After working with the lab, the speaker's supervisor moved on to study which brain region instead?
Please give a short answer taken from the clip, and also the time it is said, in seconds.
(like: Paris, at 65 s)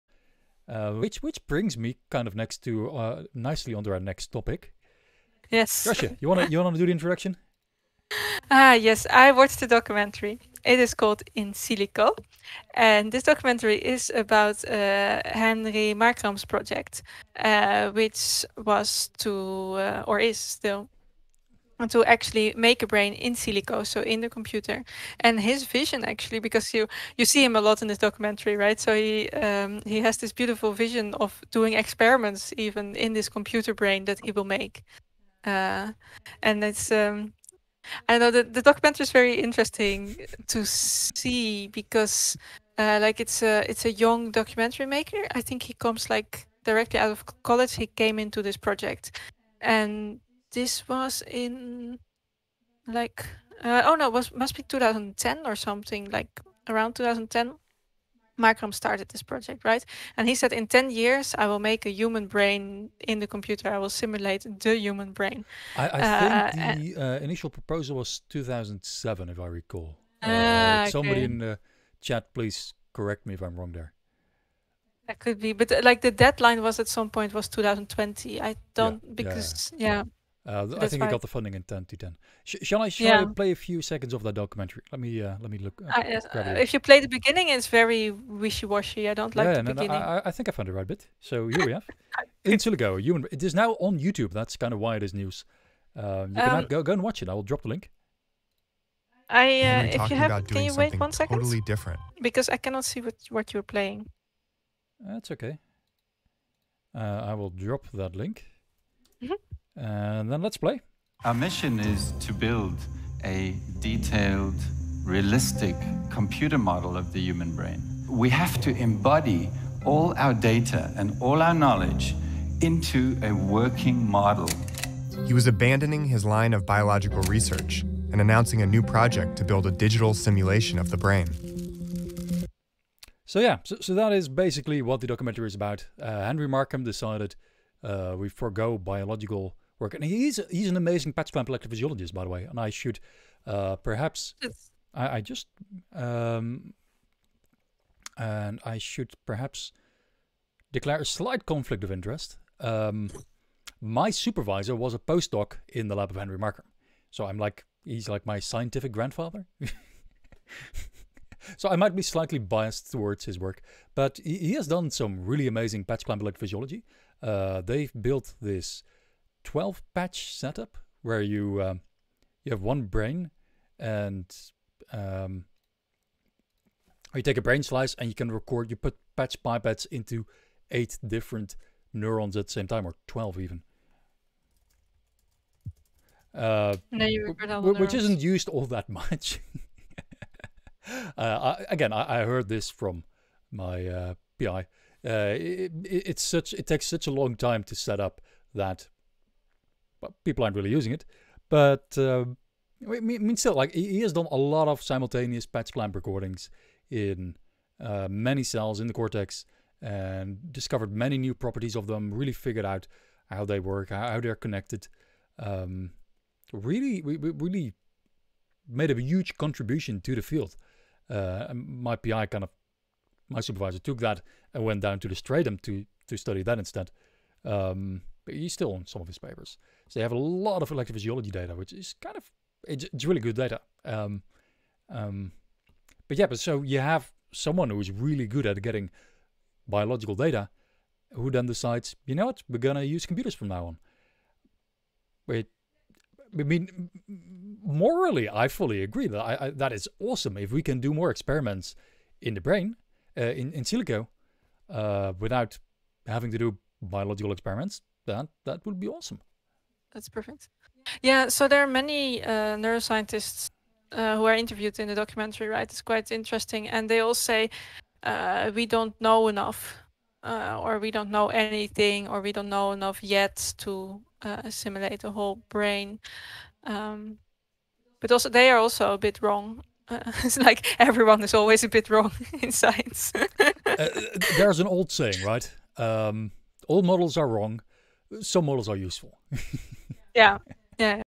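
the stratum, at 225 s.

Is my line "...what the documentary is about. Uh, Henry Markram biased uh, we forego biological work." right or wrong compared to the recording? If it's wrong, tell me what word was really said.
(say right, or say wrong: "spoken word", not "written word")
wrong: "decided", not "biased".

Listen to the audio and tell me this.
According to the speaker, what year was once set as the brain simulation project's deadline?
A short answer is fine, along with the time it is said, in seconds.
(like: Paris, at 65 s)
2020, at 77 s.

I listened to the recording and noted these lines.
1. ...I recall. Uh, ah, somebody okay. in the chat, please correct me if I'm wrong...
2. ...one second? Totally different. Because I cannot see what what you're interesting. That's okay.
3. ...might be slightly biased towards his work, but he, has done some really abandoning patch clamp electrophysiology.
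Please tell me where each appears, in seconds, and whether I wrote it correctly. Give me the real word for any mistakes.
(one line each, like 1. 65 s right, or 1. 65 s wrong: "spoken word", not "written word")
1. 69 s right
2. 100 s wrong: "playing", not "interesting"
3. 161 s wrong: "amazing", not "abandoning".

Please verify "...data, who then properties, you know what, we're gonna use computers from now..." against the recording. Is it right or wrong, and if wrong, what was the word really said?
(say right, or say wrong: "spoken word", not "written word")
wrong: "decides", not "properties".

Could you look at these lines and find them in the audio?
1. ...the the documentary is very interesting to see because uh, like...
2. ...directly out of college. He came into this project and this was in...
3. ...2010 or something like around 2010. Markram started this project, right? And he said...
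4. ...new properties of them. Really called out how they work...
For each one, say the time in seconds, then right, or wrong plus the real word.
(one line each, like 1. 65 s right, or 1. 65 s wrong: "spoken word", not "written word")
1. 38 s right
2. 46 s right
3. 54 s right
4. 211 s wrong: "figured", not "called".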